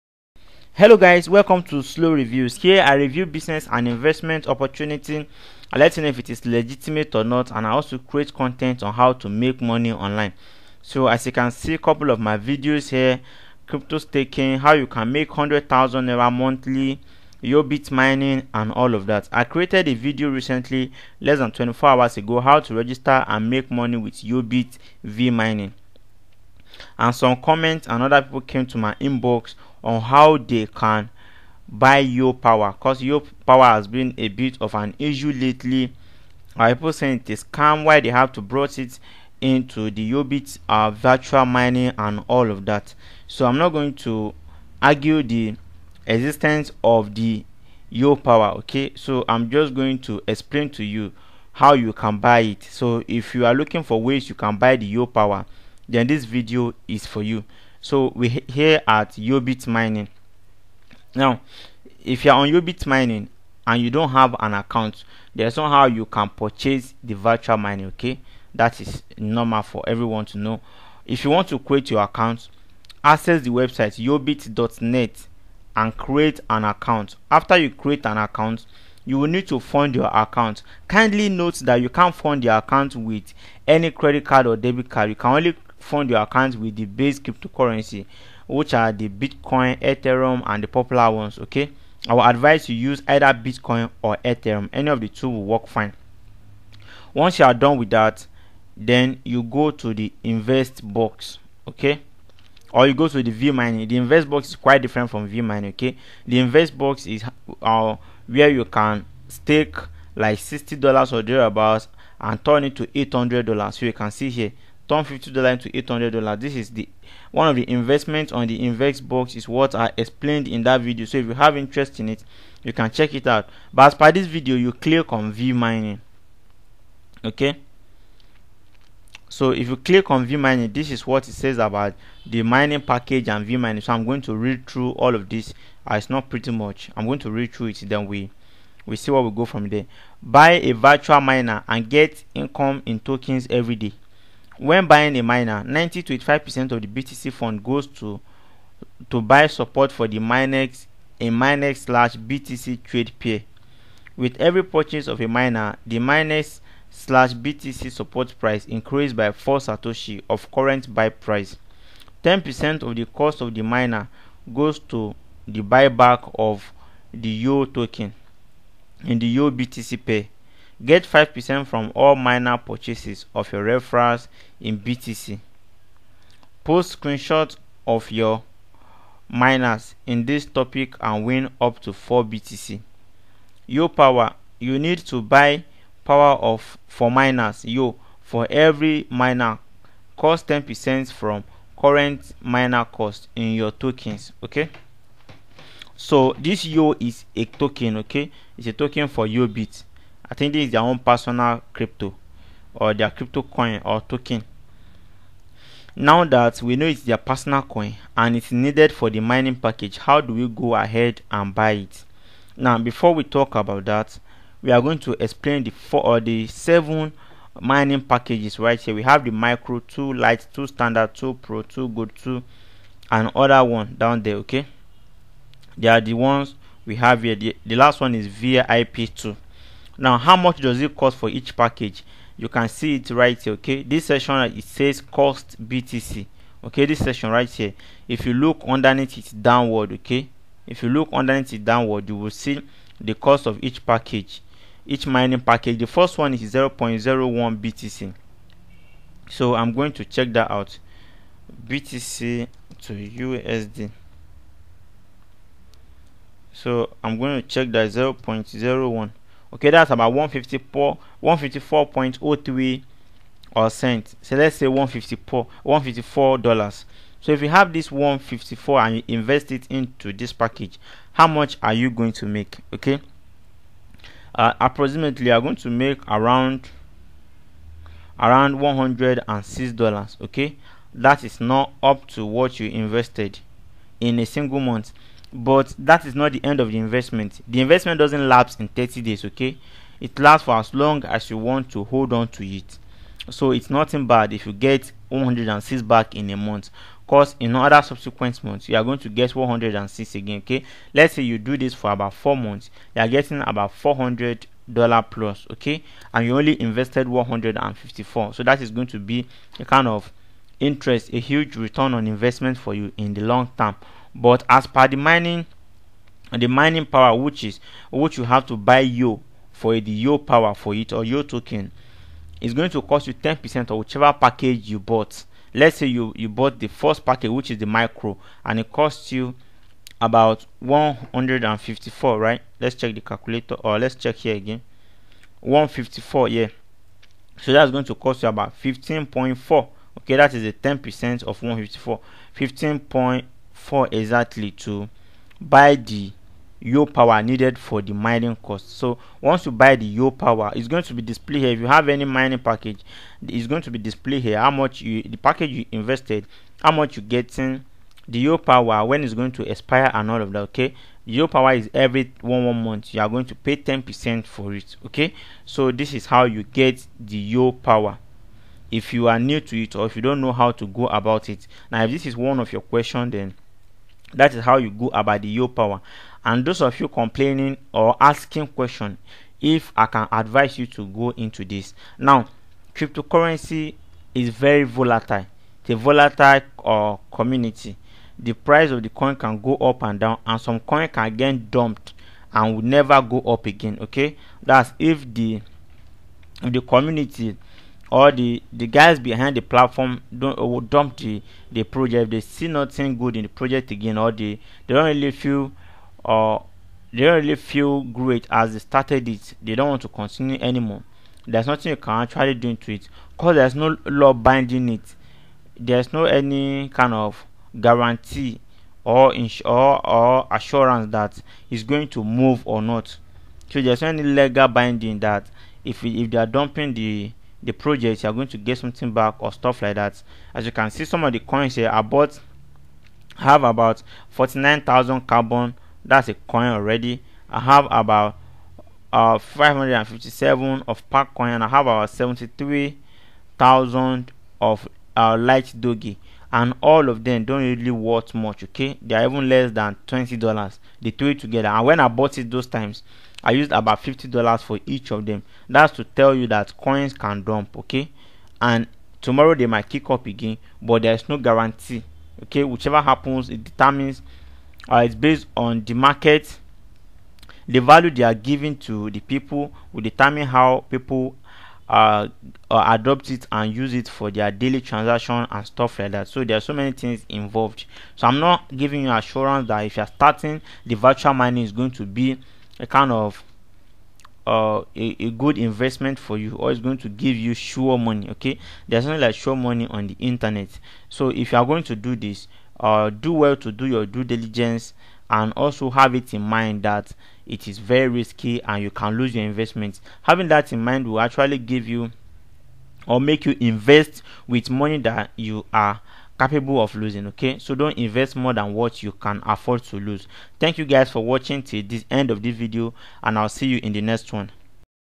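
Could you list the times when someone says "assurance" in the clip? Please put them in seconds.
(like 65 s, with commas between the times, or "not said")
420 s, 478 s.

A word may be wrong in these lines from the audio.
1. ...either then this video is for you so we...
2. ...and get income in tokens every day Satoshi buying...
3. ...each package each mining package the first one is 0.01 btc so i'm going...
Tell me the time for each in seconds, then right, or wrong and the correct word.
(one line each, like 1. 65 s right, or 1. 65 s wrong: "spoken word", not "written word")
1. 55 s wrong: "power", not "either"
2. 141 s wrong: "When", not "Satoshi"
3. 243 s right.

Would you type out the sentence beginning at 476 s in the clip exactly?
So there are so many things involved.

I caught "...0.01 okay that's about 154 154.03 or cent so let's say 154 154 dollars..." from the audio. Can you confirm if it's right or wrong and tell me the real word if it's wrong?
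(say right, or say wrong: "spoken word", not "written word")
right.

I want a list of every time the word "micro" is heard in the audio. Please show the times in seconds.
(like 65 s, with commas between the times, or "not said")
219 s, 327 s.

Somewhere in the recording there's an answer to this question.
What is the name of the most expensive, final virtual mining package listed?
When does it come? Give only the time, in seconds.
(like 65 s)
228 s.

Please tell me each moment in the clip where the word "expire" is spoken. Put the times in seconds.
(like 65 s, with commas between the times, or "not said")
359 s.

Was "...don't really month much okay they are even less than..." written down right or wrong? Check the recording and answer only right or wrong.
wrong.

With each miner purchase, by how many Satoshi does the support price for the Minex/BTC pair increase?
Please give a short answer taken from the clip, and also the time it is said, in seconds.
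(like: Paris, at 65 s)
4, at 159 s.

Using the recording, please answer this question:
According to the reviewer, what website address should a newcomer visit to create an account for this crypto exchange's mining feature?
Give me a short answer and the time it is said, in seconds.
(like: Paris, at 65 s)
yobit.net, at 74 s.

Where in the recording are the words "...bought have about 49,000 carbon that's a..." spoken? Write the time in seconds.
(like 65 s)
431 s.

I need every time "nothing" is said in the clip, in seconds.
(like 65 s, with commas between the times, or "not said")
293 s, 402 s, 411 s, 488 s.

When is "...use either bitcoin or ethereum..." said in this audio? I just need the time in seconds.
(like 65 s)
92 s.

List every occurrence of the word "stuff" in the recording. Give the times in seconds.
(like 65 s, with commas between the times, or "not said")
429 s, 475 s.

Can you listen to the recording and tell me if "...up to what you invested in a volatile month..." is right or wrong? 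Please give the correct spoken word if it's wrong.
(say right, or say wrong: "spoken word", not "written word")
wrong: "single", not "volatile".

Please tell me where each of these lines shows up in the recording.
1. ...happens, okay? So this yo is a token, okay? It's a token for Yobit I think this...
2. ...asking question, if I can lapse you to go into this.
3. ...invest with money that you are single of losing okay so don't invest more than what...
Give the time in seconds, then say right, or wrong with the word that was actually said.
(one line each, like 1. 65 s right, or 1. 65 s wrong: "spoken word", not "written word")
1. 193 s wrong: "tokens", not "happens"
2. 377 s wrong: "advise", not "lapse"
3. 503 s wrong: "capable", not "single".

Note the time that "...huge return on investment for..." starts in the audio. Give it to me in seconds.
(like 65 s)
311 s.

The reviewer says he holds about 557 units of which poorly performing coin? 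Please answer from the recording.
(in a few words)
park coin.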